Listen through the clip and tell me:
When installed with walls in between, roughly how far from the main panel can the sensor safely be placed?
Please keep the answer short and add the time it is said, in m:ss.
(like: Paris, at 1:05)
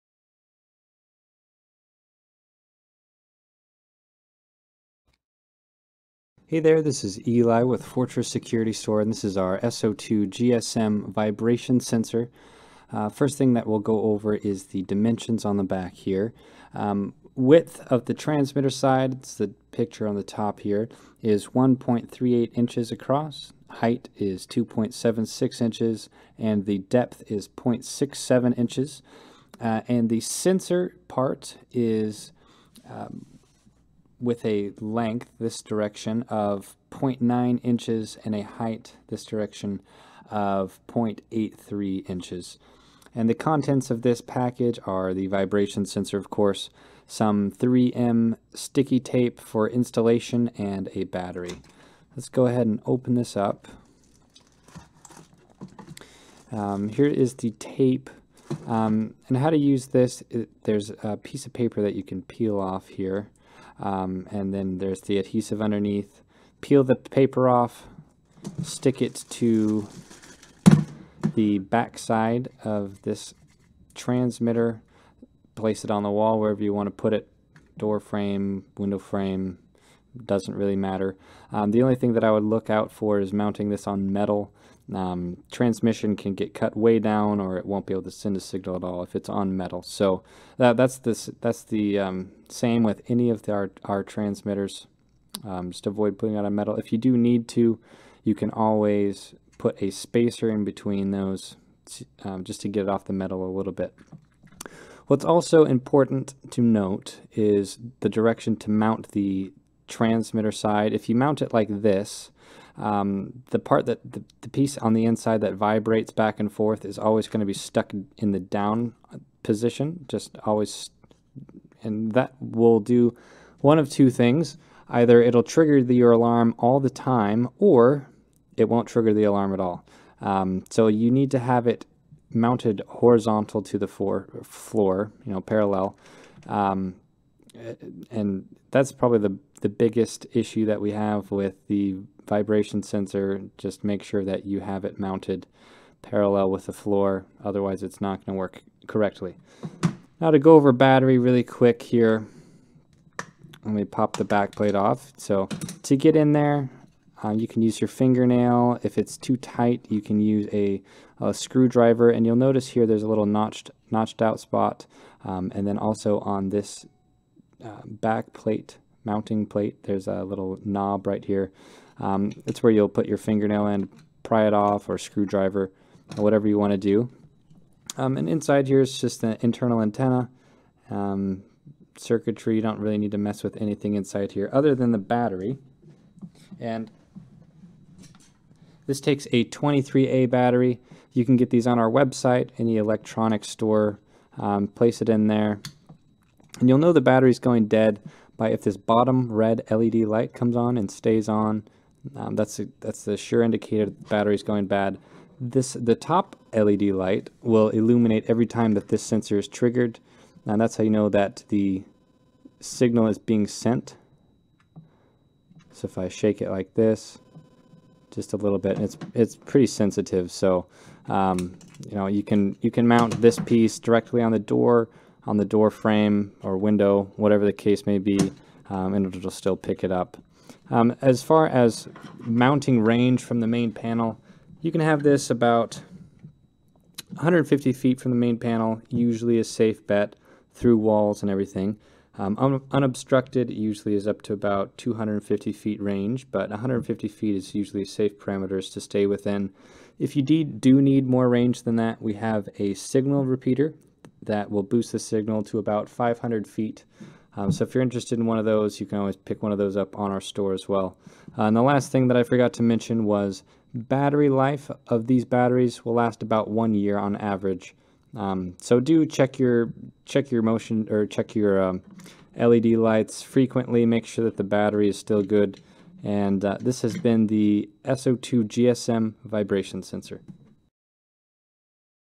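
150 feet, at 3:55.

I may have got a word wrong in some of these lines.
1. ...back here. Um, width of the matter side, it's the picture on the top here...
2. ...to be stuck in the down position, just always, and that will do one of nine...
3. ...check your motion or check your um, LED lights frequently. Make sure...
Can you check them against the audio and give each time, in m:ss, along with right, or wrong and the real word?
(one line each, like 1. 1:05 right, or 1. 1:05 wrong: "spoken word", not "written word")
1. 0:15 wrong: "transmitter", not "matter"
2. 1:57 wrong: "two", not "nine"
3. 4:30 right.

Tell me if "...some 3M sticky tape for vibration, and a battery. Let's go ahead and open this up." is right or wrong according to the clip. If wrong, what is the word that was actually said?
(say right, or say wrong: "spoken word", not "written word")
wrong: "installation", not "vibration".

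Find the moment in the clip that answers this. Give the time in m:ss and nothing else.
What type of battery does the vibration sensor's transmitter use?
3:09.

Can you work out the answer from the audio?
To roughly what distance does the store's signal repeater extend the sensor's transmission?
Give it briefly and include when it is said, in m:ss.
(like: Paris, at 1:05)
500 feet, at 4:15.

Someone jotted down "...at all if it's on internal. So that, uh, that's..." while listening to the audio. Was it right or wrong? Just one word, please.
wrong.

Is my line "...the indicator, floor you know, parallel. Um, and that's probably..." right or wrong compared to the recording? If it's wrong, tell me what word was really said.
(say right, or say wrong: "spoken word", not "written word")
wrong: "floor", not "indicator".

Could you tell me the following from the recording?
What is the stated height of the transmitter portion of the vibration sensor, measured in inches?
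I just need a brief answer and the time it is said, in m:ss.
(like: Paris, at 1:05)
2.76 inches, at 0:24.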